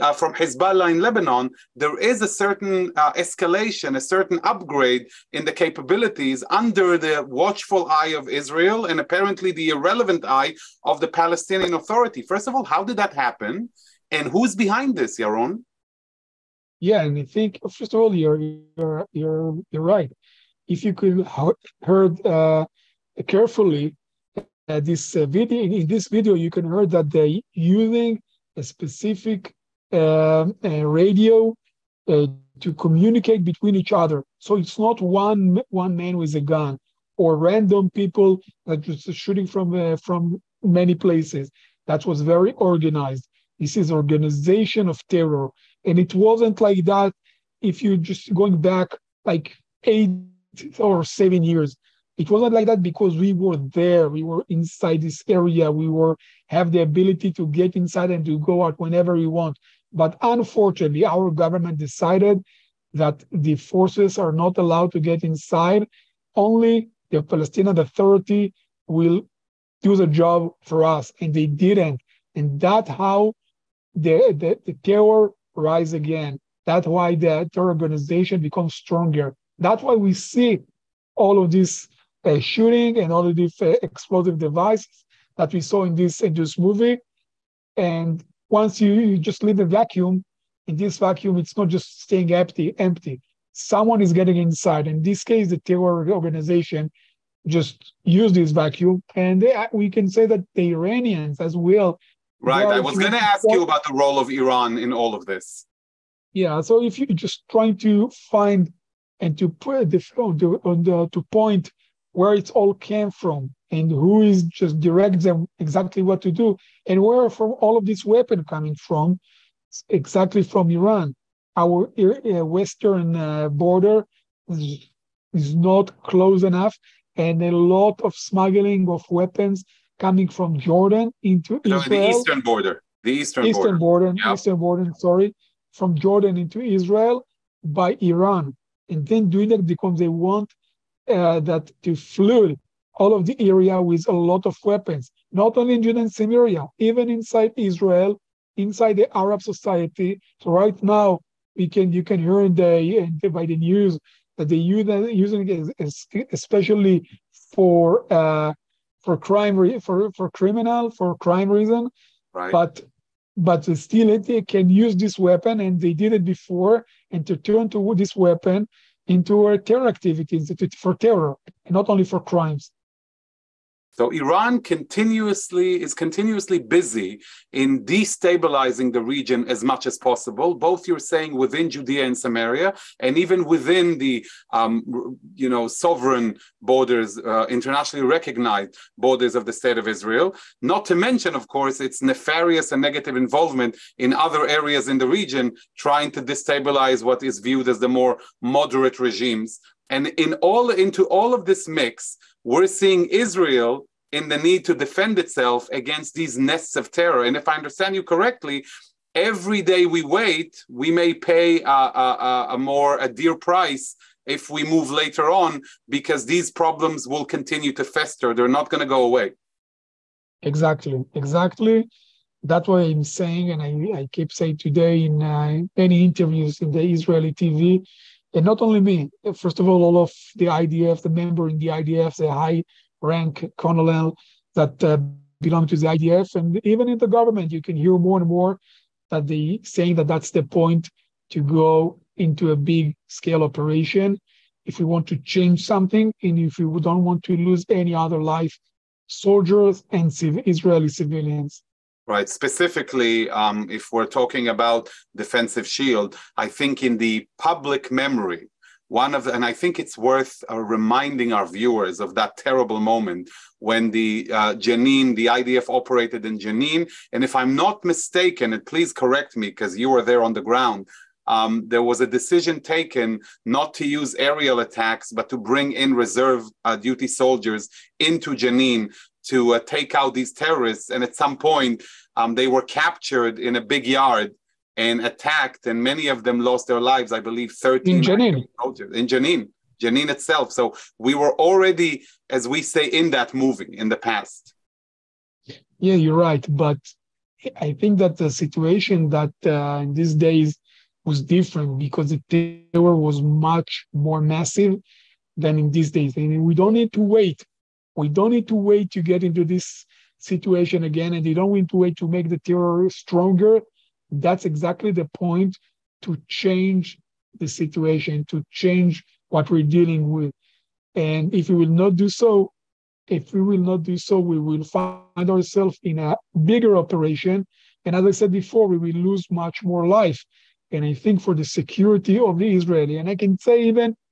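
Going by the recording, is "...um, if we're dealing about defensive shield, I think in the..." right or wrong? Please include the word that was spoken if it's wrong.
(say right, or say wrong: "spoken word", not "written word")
wrong: "talking", not "dealing".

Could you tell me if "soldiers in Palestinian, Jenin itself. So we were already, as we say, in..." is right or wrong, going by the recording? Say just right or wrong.
wrong.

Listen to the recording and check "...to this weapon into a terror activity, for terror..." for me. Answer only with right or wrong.
right.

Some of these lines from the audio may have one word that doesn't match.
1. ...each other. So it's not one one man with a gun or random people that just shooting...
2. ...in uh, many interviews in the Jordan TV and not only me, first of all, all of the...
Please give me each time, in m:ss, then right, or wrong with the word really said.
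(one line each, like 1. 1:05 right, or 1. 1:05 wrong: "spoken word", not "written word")
1. 0:33 right
2. 3:45 wrong: "Israeli", not "Jordan".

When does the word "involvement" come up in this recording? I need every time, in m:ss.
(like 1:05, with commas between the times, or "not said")
3:13.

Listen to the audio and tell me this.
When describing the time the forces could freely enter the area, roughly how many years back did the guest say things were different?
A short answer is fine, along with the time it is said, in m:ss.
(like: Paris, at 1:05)
8 or 7 years, at 0:49.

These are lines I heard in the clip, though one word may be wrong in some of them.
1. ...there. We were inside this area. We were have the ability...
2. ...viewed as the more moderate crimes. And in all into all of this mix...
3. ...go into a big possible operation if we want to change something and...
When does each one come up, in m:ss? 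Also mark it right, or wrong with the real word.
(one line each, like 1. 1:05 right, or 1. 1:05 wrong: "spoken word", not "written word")
1. 0:53 right
2. 3:17 wrong: "regimes", not "crimes"
3. 4:01 wrong: "scale", not "possible".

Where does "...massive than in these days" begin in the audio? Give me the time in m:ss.
5:04.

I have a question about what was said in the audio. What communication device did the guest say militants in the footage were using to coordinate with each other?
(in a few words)
Radio.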